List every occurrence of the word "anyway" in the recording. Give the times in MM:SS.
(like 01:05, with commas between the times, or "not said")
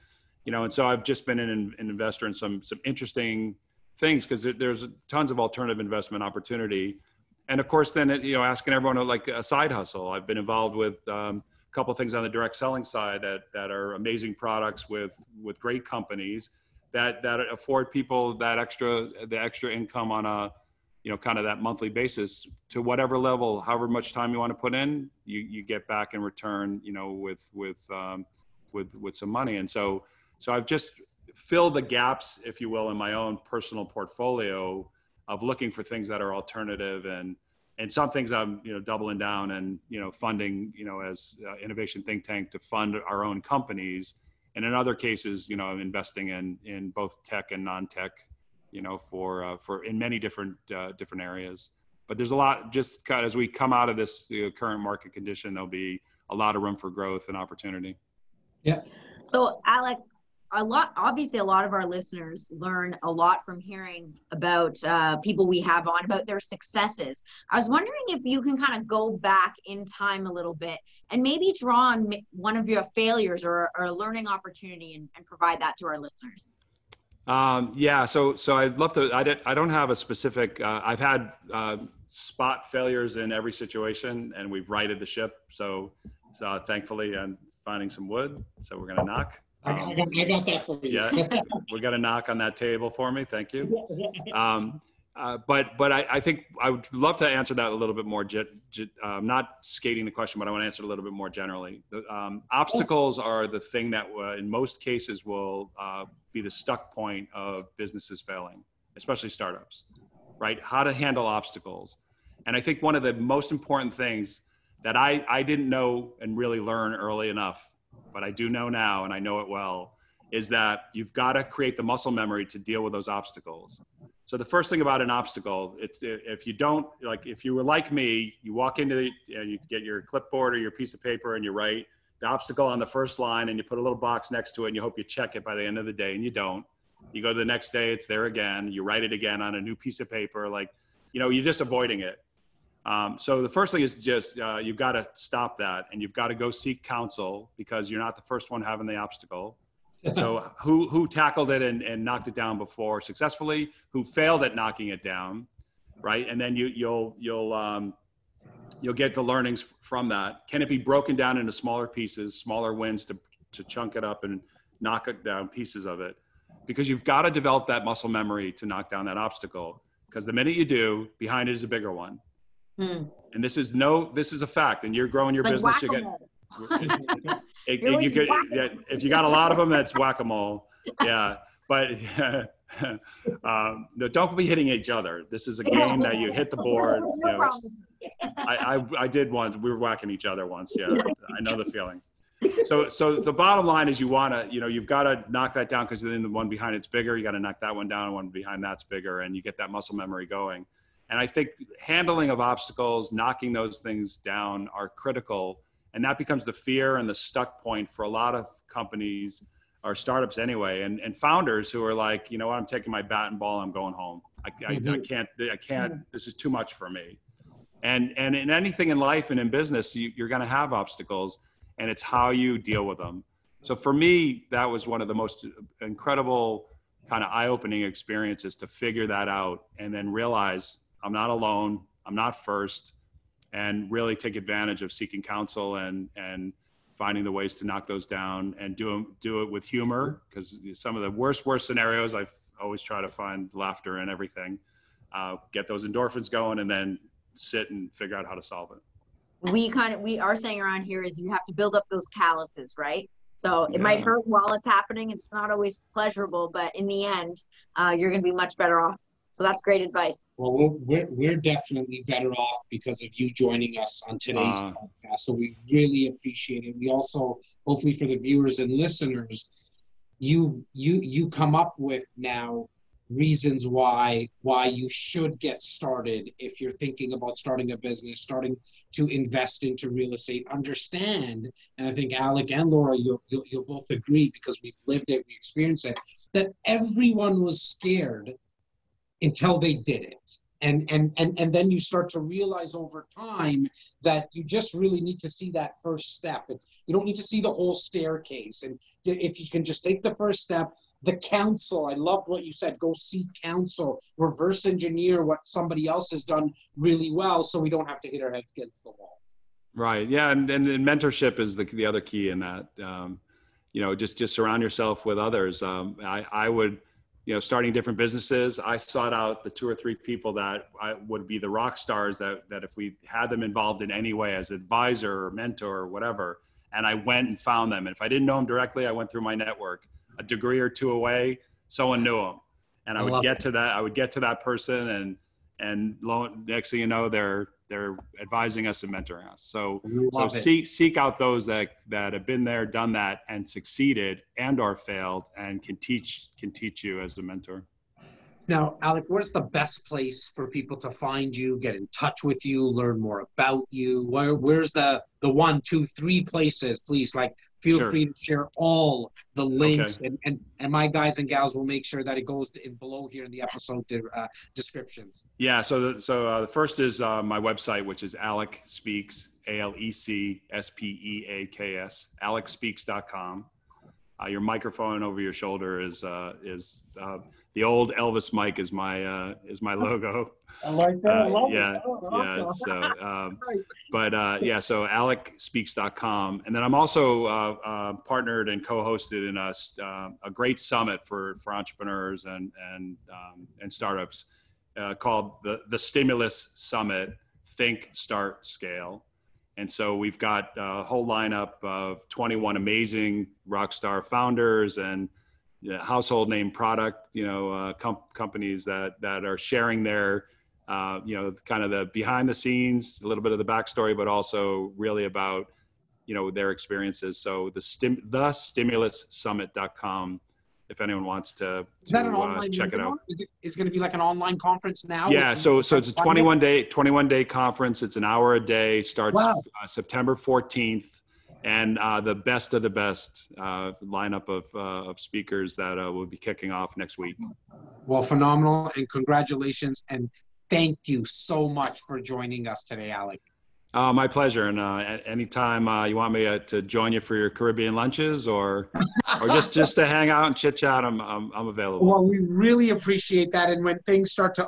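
03:30.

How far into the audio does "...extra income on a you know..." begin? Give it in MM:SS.
00:19.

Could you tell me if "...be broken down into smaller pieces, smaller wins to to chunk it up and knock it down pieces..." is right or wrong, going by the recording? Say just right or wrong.
right.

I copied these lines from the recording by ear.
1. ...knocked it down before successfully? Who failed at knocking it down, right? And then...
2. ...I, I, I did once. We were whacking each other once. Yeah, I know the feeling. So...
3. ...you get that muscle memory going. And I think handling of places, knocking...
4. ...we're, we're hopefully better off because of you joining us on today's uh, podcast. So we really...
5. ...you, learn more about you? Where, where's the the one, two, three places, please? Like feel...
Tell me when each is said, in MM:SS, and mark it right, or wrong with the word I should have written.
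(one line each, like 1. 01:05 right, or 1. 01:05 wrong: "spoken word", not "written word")
1. 02:32 right
2. 03:08 right
3. 03:19 wrong: "obstacles", not "places"
4. 04:20 wrong: "definitely", not "hopefully"
5. 05:52 right.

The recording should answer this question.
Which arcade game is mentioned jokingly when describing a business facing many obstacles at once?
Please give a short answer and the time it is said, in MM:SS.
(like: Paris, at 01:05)
whack a mole, at 02:59.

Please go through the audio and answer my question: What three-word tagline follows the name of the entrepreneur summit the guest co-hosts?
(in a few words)
Think, Start, Scale.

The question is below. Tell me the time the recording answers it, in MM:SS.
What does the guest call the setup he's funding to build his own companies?
00:41.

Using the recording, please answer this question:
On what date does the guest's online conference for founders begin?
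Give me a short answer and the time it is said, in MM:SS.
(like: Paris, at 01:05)
September 14, at 07:09.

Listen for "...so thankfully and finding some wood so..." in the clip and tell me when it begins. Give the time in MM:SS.
01:26.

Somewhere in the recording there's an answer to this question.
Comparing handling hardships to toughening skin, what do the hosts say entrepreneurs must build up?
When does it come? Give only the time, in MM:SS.
04:12.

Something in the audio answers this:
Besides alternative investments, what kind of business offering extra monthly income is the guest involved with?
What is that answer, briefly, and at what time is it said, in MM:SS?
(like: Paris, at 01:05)
direct selling, at 00:12.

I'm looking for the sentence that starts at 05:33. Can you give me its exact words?
to that i would get to that person and and lo, next thing you know they're they're advising us and mentoring us.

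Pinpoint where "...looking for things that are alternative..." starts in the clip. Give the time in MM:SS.
00:35.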